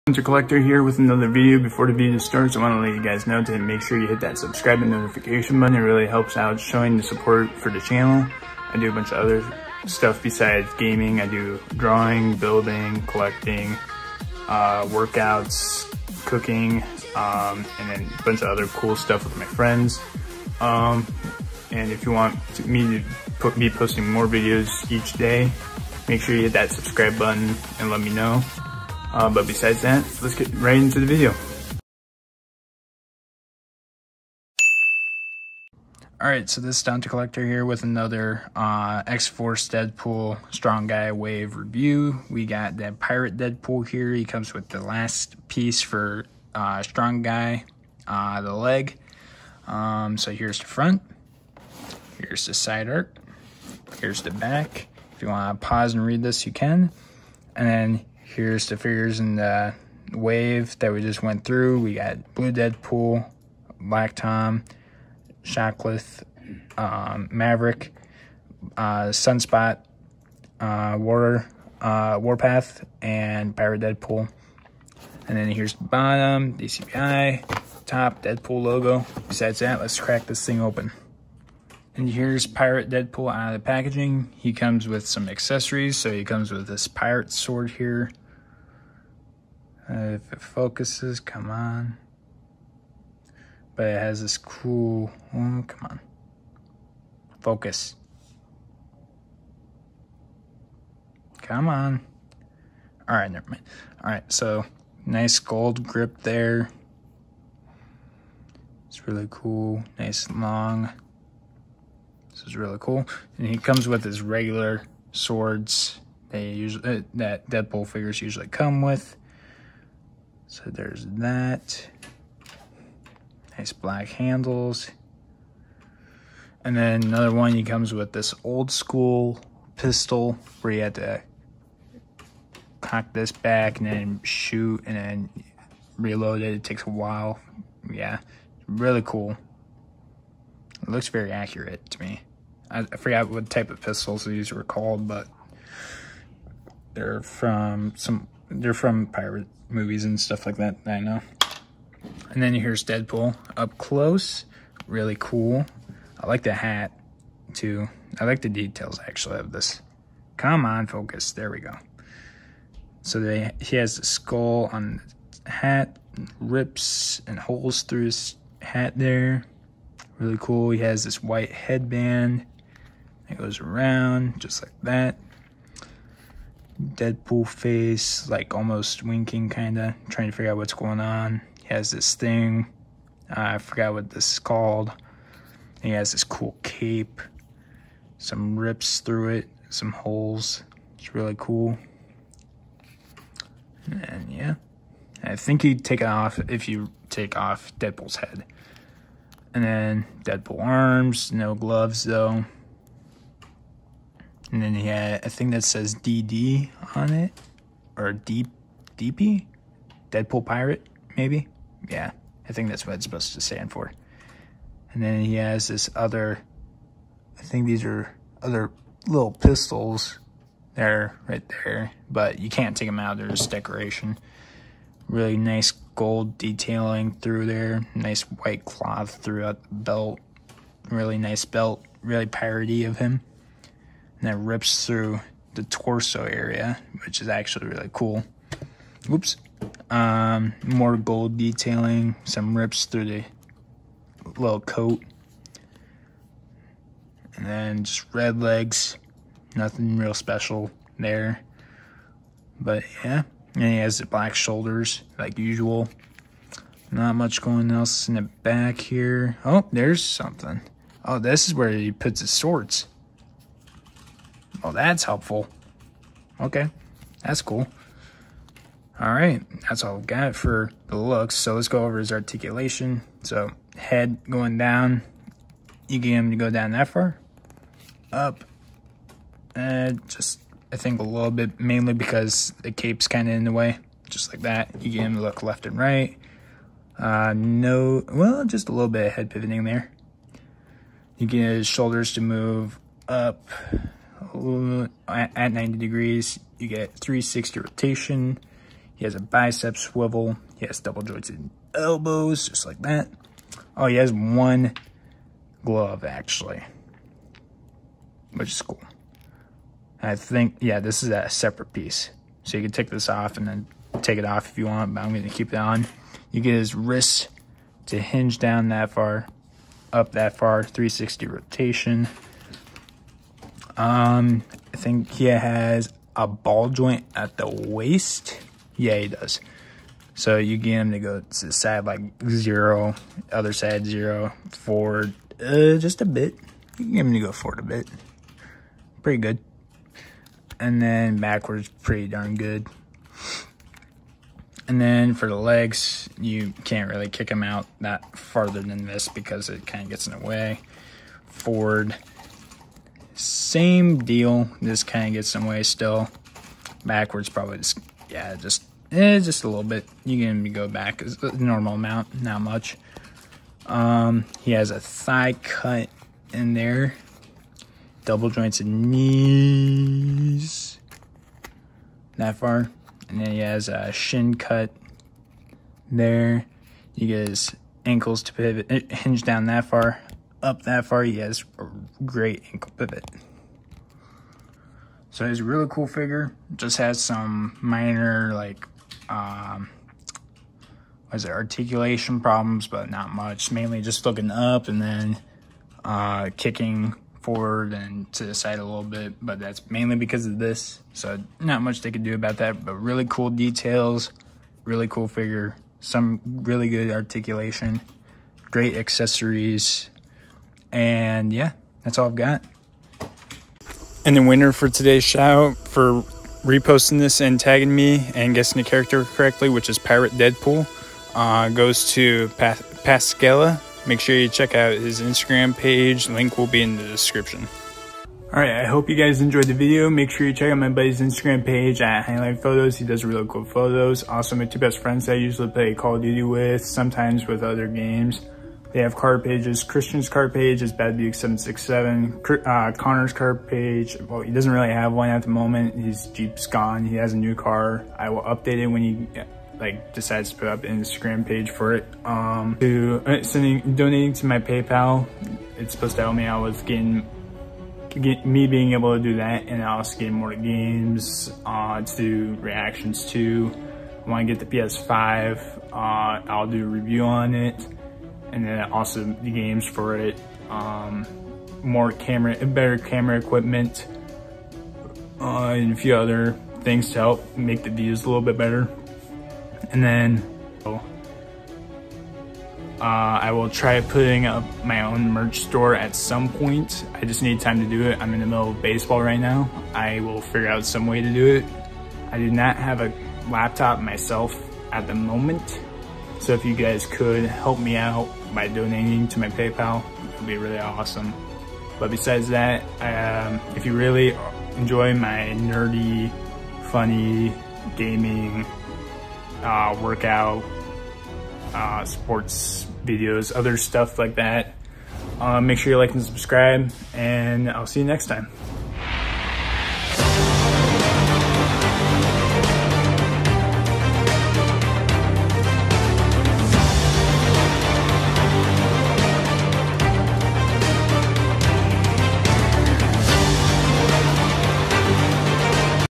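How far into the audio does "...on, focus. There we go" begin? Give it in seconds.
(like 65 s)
160 s.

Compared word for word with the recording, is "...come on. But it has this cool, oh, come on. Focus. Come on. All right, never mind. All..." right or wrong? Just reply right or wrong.
right.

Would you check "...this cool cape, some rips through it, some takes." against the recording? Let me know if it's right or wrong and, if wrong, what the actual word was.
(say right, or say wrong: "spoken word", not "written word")
wrong: "holes", not "takes".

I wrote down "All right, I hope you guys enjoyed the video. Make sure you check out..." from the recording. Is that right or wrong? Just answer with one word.
right.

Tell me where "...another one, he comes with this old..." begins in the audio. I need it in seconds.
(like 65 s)
127 s.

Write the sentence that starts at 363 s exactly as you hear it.
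Um, he has a thigh cut in there.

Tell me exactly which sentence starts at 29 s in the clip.
Uh, but besides that, let's get right into the video.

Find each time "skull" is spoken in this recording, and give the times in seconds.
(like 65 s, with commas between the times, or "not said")
164 s.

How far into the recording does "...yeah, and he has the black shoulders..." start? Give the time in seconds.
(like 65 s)
253 s.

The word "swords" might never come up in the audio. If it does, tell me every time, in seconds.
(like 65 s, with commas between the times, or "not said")
87 s, 115 s, 262 s.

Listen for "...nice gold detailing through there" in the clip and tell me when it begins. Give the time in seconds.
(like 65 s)
225 s.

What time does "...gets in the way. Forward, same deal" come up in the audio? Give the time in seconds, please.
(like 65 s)
349 s.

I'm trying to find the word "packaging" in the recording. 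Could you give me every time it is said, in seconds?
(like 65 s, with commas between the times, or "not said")
83 s.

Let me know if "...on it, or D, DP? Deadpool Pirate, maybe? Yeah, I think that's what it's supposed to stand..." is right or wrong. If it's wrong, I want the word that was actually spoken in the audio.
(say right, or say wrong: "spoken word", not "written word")
right.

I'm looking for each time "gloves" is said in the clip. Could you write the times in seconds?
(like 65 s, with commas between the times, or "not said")
201 s, 305 s.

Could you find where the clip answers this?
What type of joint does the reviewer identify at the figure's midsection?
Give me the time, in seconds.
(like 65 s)
326 s.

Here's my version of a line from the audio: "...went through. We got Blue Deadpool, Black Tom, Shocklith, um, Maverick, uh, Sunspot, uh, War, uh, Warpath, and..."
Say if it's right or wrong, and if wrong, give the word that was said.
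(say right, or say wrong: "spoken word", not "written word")
right.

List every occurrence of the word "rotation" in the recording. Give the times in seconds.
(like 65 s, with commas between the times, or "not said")
297 s, 321 s.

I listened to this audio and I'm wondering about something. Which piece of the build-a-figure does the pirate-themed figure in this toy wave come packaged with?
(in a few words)
The leg.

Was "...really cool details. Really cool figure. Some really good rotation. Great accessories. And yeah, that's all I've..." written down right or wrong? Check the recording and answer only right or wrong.
wrong.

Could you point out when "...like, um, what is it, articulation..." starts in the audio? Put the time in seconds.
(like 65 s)
388 s.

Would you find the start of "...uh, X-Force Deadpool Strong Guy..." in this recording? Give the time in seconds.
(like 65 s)
38 s.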